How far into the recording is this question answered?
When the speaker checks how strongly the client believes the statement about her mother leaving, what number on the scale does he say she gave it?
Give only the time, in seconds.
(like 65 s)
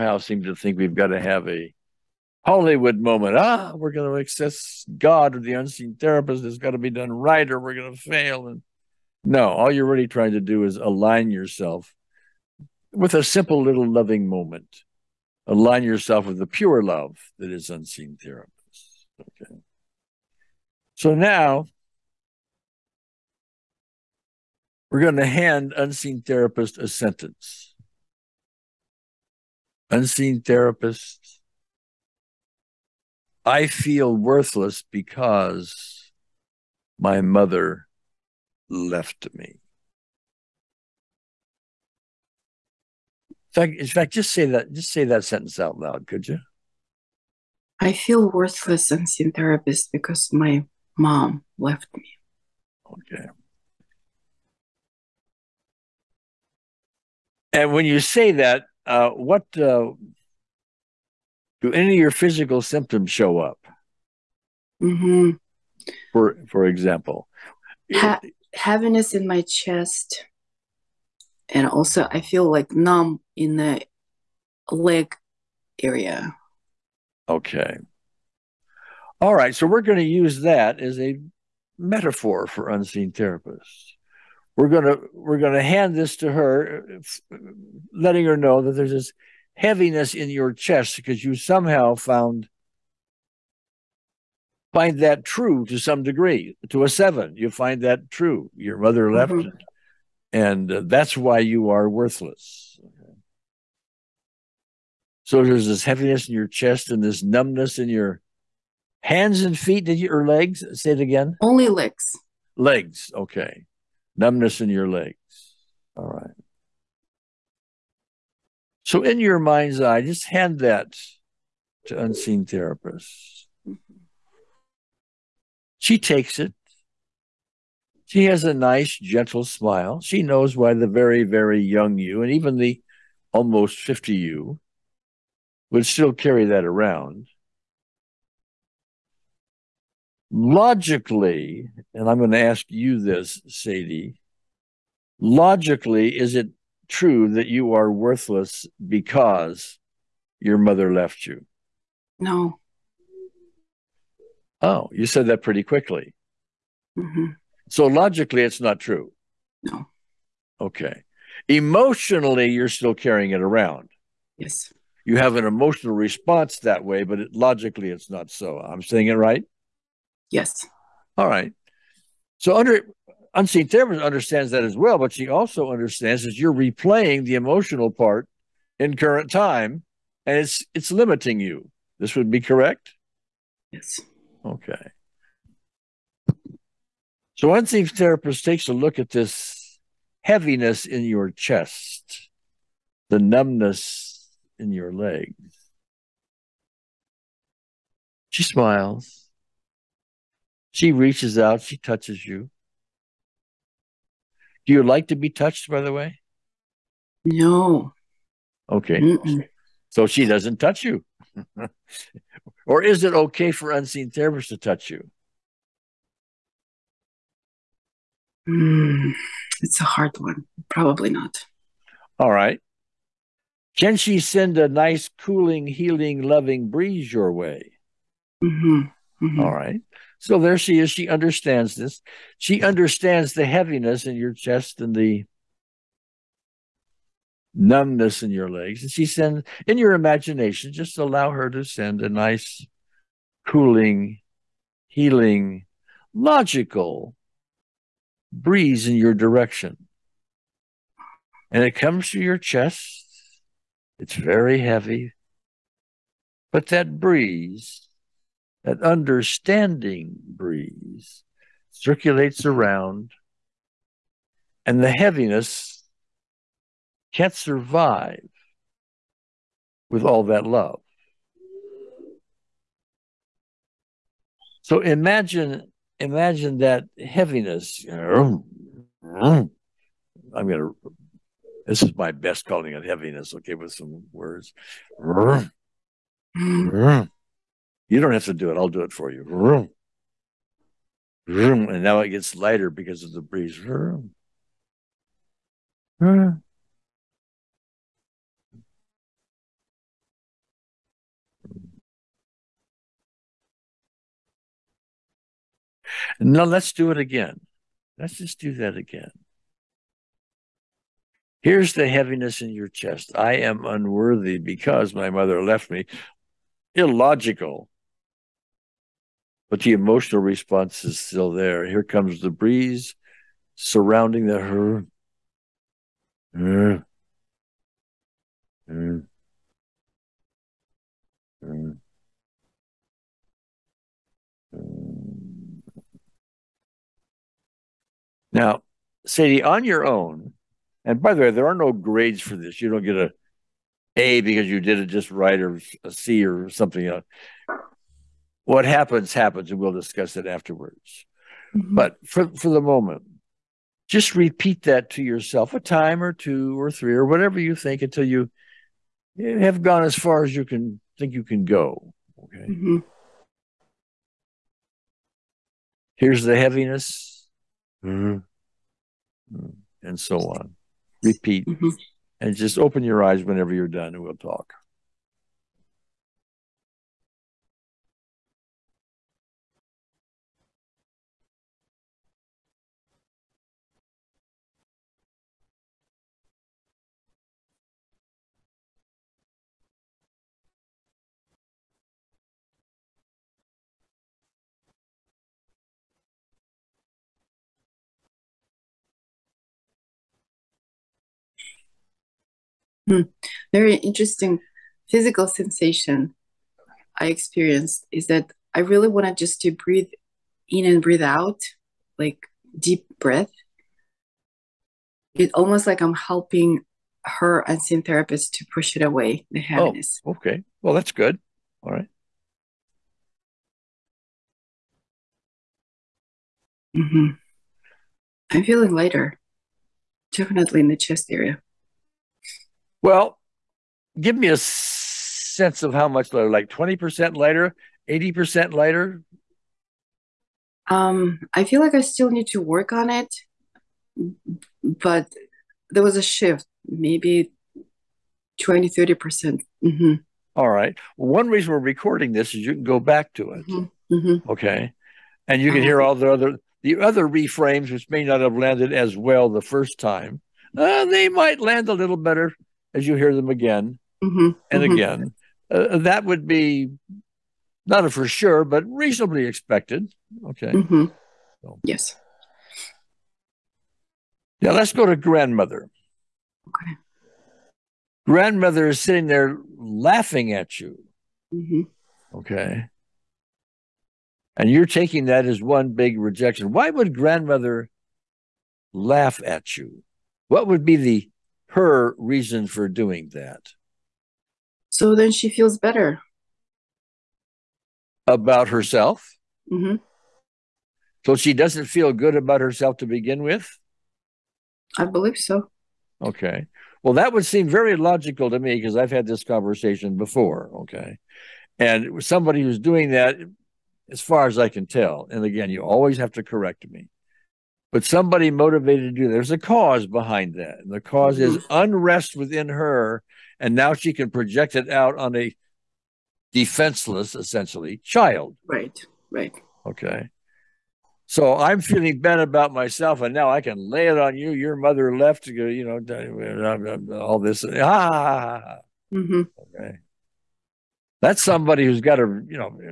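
96 s.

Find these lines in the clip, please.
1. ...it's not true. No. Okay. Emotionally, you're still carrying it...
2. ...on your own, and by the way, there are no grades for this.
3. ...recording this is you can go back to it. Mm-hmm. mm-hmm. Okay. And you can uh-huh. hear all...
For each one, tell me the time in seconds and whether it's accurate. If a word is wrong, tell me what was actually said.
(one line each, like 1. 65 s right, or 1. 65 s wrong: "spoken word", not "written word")
1. 158 s right
2. 339 s right
3. 451 s right.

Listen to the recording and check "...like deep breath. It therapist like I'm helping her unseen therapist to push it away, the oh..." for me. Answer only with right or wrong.
wrong.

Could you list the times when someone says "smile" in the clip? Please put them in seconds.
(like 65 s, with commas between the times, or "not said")
129 s, 198 s.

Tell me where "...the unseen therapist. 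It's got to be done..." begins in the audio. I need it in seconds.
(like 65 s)
5 s.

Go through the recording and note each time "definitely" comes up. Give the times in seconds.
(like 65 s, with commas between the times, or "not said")
430 s.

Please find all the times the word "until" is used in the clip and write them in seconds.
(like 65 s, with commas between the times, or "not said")
357 s.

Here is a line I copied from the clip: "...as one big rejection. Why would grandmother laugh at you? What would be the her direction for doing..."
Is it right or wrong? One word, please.
wrong.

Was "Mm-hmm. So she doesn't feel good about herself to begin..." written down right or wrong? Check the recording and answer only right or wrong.
right.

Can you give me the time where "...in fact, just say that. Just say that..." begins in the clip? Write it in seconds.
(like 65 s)
43 s.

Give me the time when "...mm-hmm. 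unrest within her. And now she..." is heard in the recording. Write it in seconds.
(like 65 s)
521 s.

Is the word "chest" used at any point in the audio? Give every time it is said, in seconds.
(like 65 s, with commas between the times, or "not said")
69 s, 90 s, 106 s, 191 s, 234 s, 252 s, 312 s, 430 s.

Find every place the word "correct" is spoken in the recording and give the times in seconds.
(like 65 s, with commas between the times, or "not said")
182 s, 516 s.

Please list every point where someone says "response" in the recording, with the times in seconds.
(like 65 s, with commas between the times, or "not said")
165 s, 320 s.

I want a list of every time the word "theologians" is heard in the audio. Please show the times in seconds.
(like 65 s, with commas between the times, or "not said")
not said.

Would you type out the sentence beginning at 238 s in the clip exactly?
And she sends, in your imagination, just allow her to send a nice, cooling, healing, logical breeze in your direction.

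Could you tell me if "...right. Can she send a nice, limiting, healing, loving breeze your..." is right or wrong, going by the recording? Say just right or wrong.
wrong.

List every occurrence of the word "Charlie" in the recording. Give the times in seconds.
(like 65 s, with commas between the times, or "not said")
not said.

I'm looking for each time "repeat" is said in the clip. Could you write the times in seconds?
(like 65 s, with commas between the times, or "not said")
354 s, 371 s.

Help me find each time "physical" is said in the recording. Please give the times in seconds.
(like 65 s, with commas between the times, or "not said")
62 s, 404 s.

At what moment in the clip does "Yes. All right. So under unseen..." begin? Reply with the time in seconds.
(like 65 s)
170 s.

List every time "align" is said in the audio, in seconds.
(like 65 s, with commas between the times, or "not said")
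10 s, 15 s.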